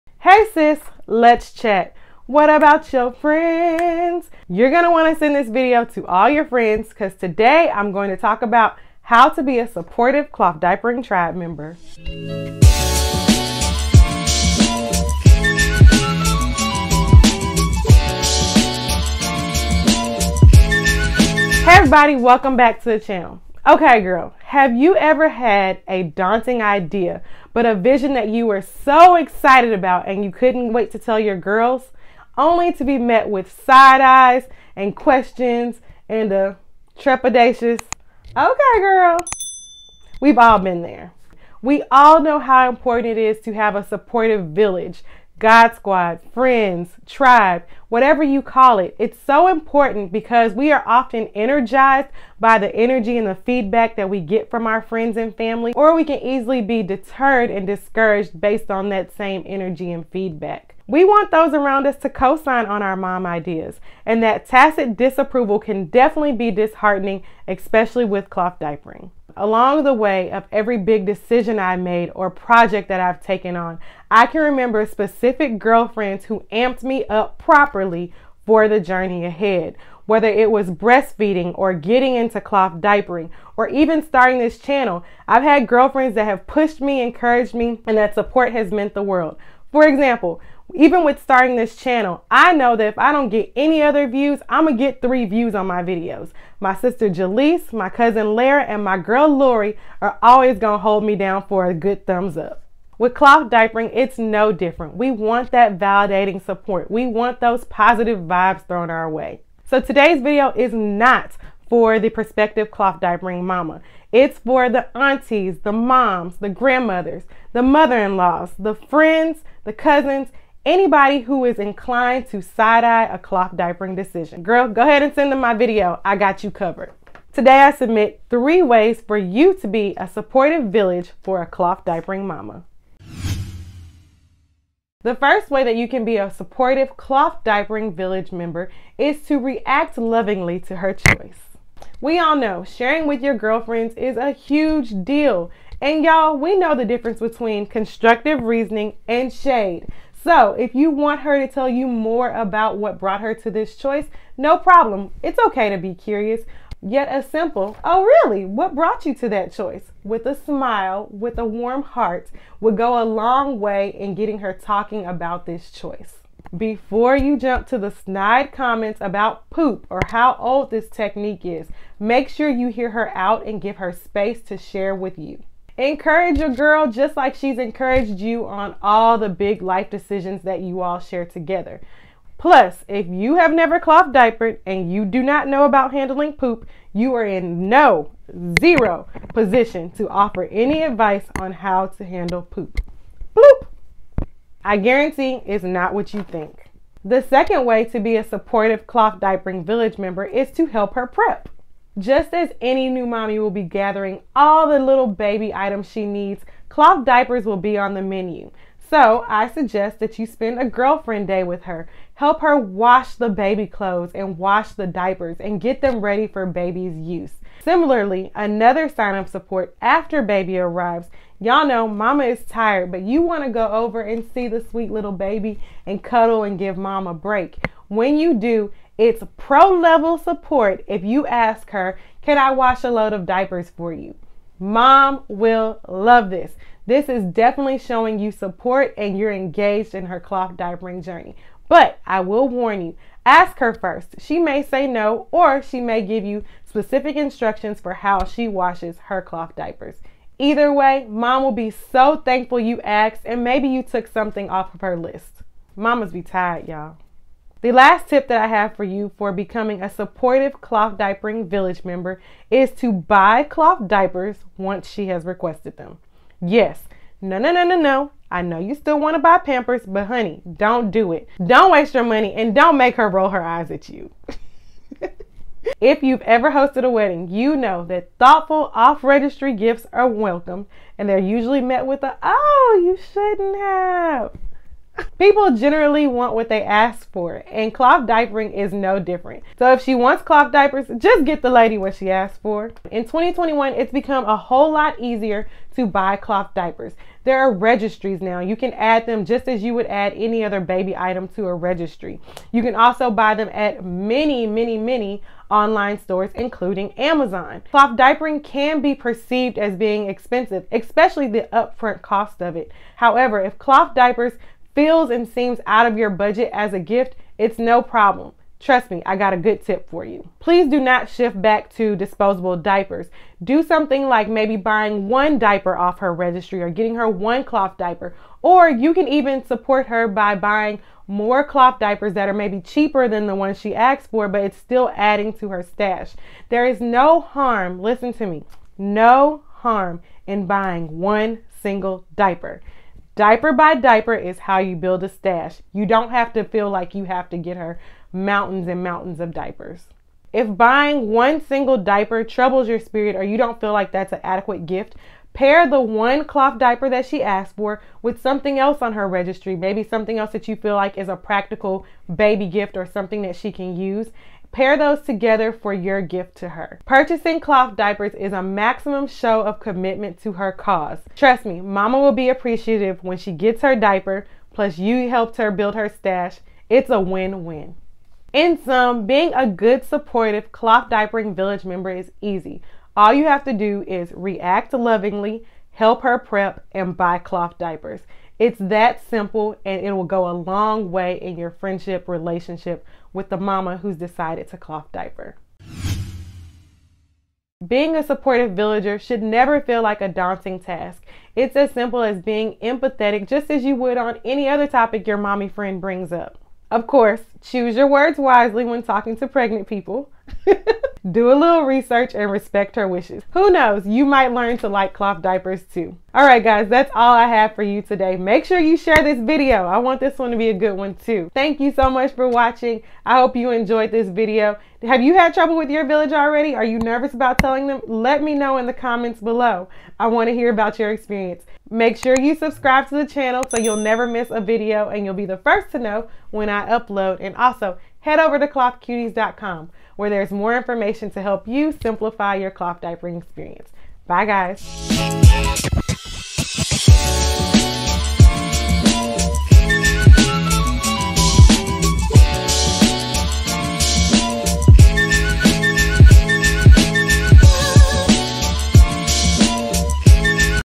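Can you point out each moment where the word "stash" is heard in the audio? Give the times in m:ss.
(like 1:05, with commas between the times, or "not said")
5:35, 5:45, 6:15.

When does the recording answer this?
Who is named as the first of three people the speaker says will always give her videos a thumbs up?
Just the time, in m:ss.
1:36.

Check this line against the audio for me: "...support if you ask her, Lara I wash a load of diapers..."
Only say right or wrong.
wrong.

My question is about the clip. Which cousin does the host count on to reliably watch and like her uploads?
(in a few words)
Lara.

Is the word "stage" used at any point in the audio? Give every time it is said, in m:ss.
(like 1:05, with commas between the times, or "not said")
not said.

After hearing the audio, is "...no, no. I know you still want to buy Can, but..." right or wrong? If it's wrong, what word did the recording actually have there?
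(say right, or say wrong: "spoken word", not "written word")
wrong: "Pampers", not "Can".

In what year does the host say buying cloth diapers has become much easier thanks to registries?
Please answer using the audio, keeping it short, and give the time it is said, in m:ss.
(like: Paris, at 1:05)
2021, at 4:53.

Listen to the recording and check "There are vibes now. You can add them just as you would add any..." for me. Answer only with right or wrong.
wrong.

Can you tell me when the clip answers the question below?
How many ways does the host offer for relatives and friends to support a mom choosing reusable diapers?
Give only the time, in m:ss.
2:08.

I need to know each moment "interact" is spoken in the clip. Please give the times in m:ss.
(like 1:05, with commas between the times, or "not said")
not said.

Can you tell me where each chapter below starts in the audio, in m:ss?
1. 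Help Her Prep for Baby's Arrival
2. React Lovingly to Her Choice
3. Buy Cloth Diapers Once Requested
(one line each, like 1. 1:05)
1. 3:23
2. 2:21
3. 4:26.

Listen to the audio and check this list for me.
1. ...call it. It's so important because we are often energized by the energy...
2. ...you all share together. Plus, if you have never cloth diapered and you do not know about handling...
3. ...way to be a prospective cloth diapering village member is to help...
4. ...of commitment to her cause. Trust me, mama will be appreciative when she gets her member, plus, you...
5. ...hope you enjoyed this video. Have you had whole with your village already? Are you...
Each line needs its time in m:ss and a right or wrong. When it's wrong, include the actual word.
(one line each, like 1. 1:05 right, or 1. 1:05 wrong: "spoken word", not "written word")
1. 0:48 right
2. 3:00 right
3. 3:17 wrong: "supportive", not "prospective"
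4. 6:09 wrong: "diaper", not "member"
5. 7:03 wrong: "trouble", not "whole".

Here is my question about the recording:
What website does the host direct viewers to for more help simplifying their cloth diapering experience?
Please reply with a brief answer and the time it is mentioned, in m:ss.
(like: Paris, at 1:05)
clothcuties.com, at 7:18.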